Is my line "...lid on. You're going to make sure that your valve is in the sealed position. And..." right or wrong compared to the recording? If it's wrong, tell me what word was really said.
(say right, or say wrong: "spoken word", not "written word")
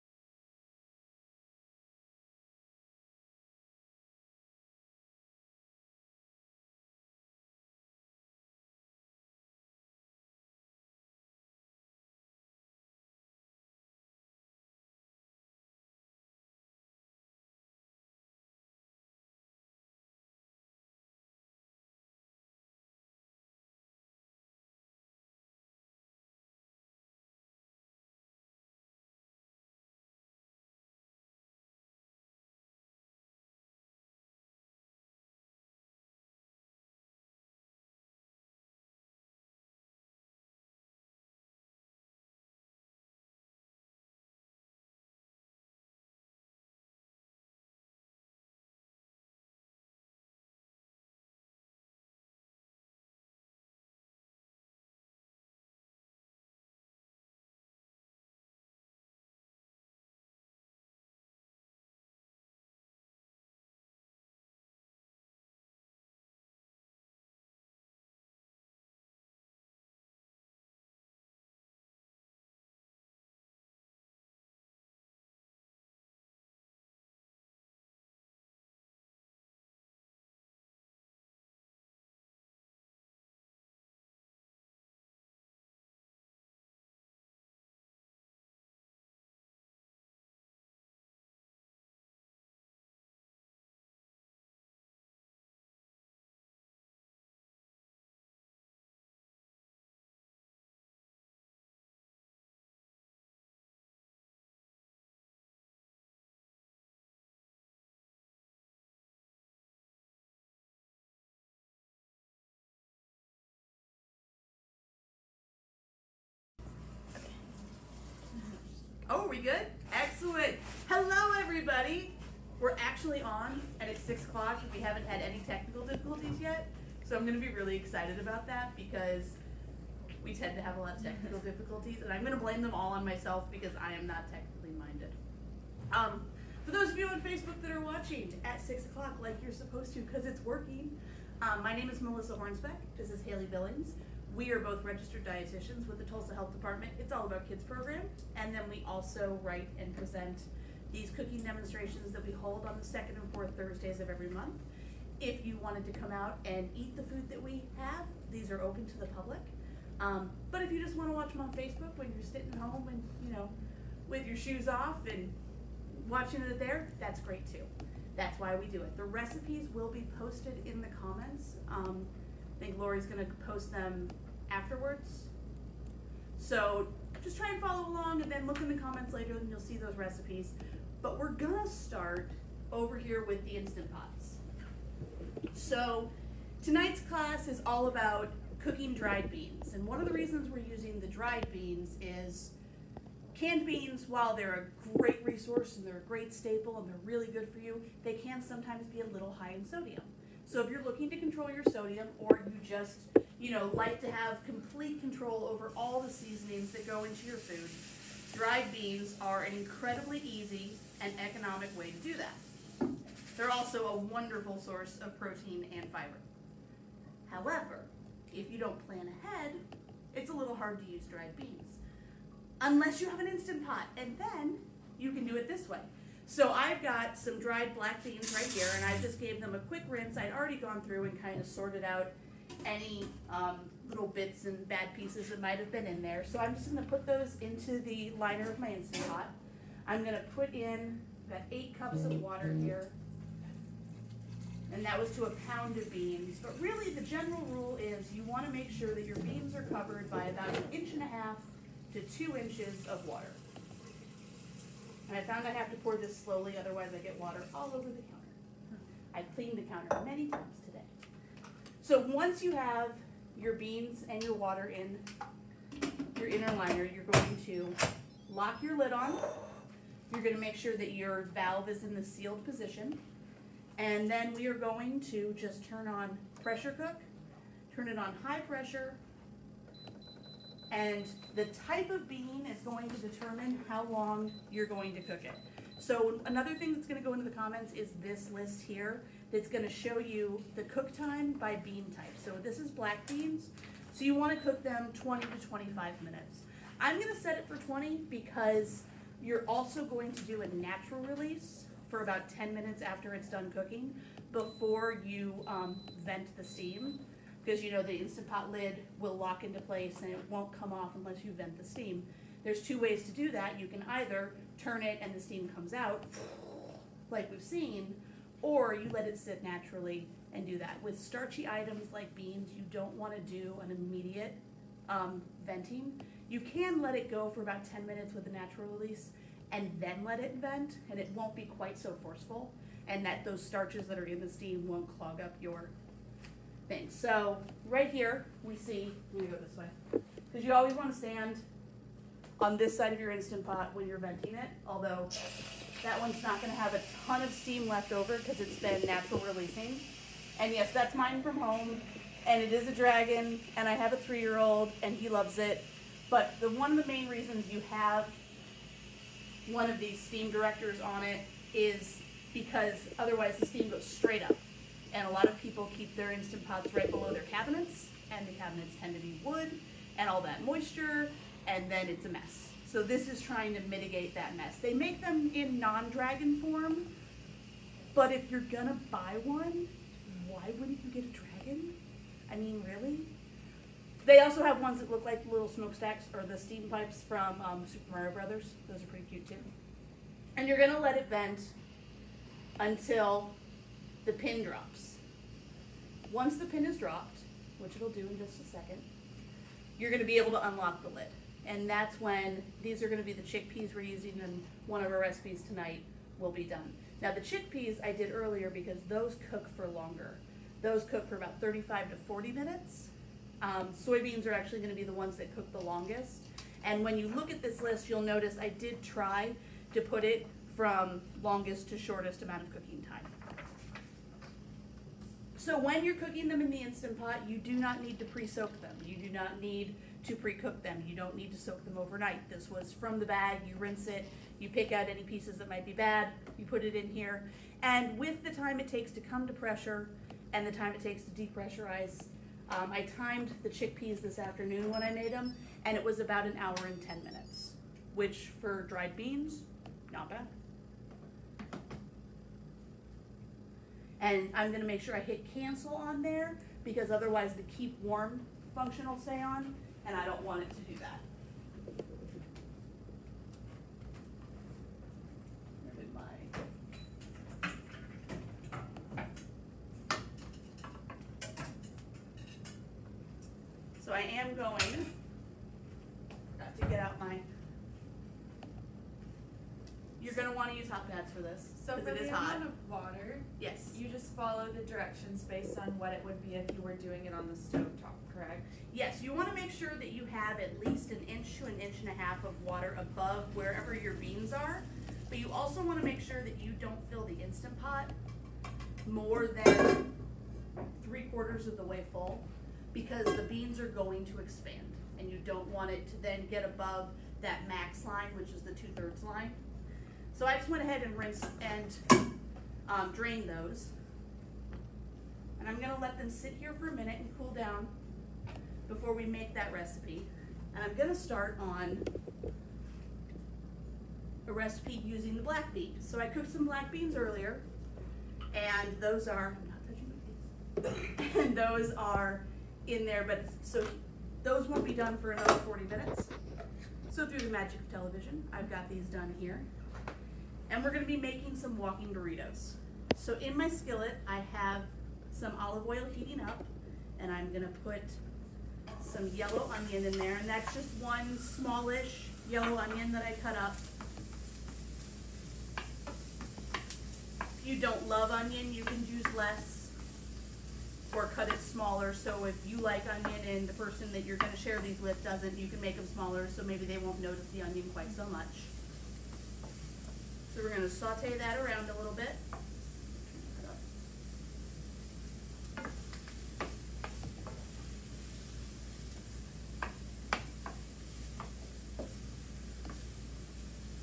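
right.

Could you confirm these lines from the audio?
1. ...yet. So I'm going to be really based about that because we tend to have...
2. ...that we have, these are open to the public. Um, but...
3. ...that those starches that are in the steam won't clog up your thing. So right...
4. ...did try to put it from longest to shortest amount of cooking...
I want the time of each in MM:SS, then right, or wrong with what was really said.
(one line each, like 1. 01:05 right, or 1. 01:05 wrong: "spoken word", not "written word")
1. 02:06 wrong: "excited", not "based"
2. 02:37 right
3. 05:33 right
4. 06:58 right.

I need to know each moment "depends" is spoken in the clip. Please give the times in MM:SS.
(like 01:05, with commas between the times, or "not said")
not said.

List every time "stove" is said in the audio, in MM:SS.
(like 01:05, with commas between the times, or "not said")
08:07.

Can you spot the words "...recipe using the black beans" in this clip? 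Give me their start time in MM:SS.
08:44.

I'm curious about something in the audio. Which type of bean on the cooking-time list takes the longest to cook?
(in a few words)
Soybeans.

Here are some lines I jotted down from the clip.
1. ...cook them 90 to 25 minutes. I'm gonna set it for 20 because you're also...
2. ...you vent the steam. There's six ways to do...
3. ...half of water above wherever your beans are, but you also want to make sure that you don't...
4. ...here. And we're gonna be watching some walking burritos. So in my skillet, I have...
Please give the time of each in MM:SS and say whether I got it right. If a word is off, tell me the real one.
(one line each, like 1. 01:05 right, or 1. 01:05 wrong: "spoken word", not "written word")
1. 04:54 wrong: "20", not "90"
2. 05:11 wrong: "two", not "six"
3. 08:11 right
4. 08:59 wrong: "making", not "watching".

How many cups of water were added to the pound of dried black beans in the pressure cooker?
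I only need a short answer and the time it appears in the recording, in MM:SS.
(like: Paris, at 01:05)
8, at 04:01.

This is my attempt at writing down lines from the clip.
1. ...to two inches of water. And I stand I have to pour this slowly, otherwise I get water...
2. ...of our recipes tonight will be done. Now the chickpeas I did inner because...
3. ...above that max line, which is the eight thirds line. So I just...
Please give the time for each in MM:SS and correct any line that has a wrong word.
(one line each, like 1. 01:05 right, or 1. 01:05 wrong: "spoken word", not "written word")
1. 04:11 wrong: "found", not "stand"
2. 06:44 wrong: "earlier", not "inner"
3. 08:26 wrong: "two", not "eight".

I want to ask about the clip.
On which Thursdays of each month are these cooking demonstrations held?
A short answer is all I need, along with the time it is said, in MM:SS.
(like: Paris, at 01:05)
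Second and fourth, at 02:32.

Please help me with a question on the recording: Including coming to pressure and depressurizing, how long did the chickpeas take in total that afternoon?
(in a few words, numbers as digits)
1 hour 10 minutes.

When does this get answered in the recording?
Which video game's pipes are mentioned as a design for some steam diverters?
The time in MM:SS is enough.
06:27.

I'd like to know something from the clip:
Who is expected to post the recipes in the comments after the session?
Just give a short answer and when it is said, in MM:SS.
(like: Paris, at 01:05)
Lori, at 02:52.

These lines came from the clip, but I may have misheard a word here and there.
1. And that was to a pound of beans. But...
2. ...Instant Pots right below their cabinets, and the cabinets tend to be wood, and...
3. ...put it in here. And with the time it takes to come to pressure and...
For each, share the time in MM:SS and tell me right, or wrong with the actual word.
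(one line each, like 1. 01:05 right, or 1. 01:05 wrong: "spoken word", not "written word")
1. 04:04 right
2. 06:06 right
3. 07:16 right.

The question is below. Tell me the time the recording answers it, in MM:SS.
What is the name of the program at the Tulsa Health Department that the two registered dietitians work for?
02:26.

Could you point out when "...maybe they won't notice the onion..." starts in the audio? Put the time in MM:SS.
09:26.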